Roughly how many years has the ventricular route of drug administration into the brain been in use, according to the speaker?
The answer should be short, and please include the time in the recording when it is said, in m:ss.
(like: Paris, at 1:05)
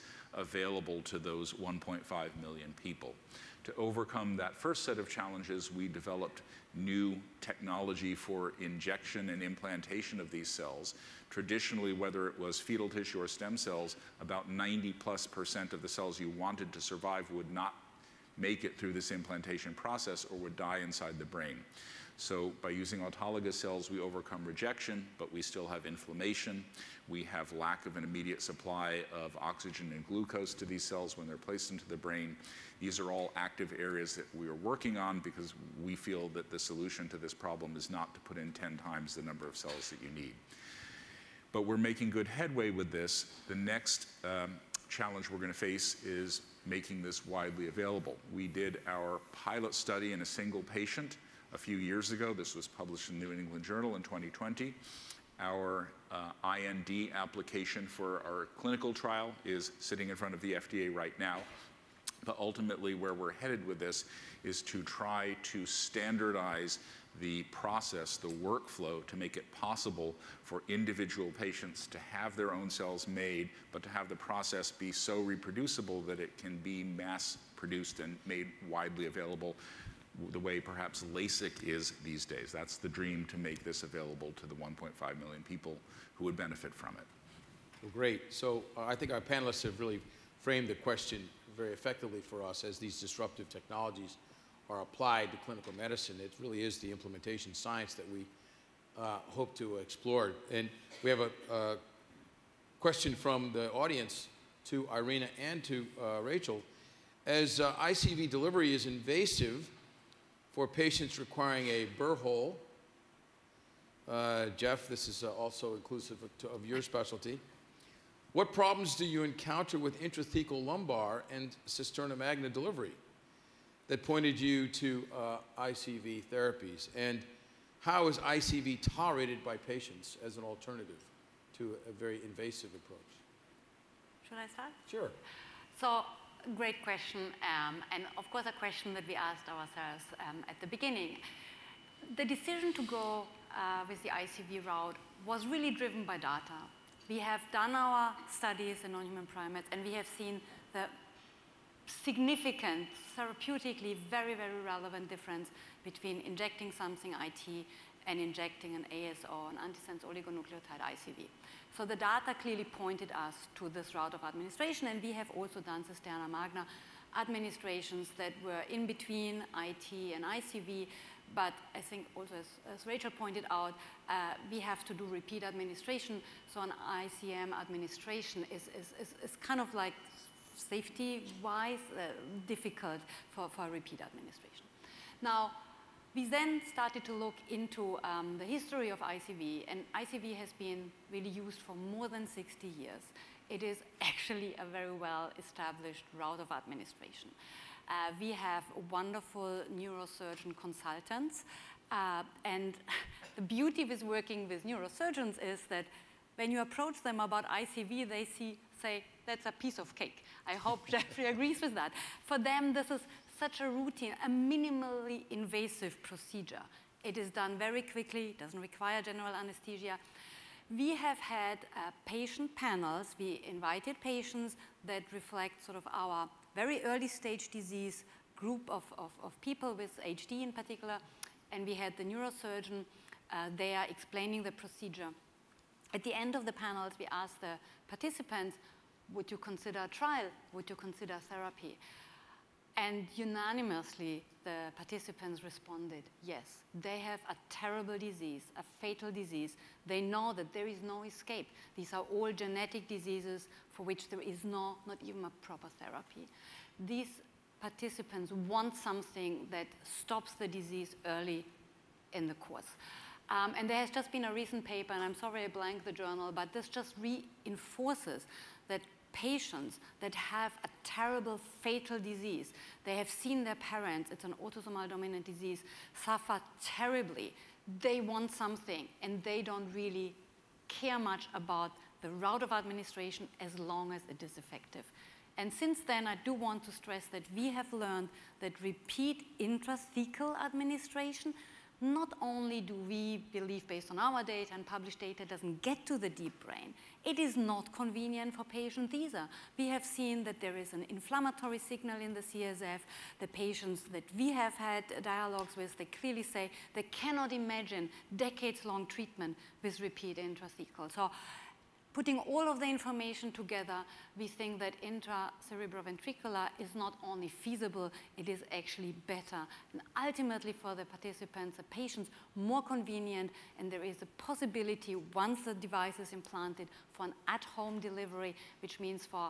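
60, at 3:12.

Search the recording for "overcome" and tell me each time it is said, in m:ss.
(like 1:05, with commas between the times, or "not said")
0:03, 0:23.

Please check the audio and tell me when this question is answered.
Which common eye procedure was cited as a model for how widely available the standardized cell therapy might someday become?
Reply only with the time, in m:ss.
1:21.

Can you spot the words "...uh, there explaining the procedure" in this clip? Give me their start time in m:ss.
3:53.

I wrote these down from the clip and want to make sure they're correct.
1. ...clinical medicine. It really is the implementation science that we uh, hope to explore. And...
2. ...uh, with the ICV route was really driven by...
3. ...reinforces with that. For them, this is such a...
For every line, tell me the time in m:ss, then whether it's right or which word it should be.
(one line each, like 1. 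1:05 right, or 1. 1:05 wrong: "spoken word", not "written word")
1. 1:35 right
2. 2:23 right
3. 3:31 wrong: "agrees", not "reinforces".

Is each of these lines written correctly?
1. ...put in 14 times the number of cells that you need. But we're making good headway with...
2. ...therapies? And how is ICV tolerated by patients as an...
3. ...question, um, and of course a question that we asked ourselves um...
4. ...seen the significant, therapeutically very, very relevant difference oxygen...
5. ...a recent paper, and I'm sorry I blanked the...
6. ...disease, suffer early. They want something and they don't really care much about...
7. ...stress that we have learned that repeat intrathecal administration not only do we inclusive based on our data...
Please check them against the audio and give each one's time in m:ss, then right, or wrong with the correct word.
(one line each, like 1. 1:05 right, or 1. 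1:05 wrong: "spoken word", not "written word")
1. 0:38 wrong: "10", not "14"
2. 2:06 right
3. 2:16 right
4. 2:30 wrong: "between", not "oxygen"
5. 4:24 right
6. 4:35 wrong: "terribly", not "early"
7. 4:46 wrong: "believe", not "inclusive".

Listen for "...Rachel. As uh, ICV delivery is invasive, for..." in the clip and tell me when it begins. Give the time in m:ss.
1:46.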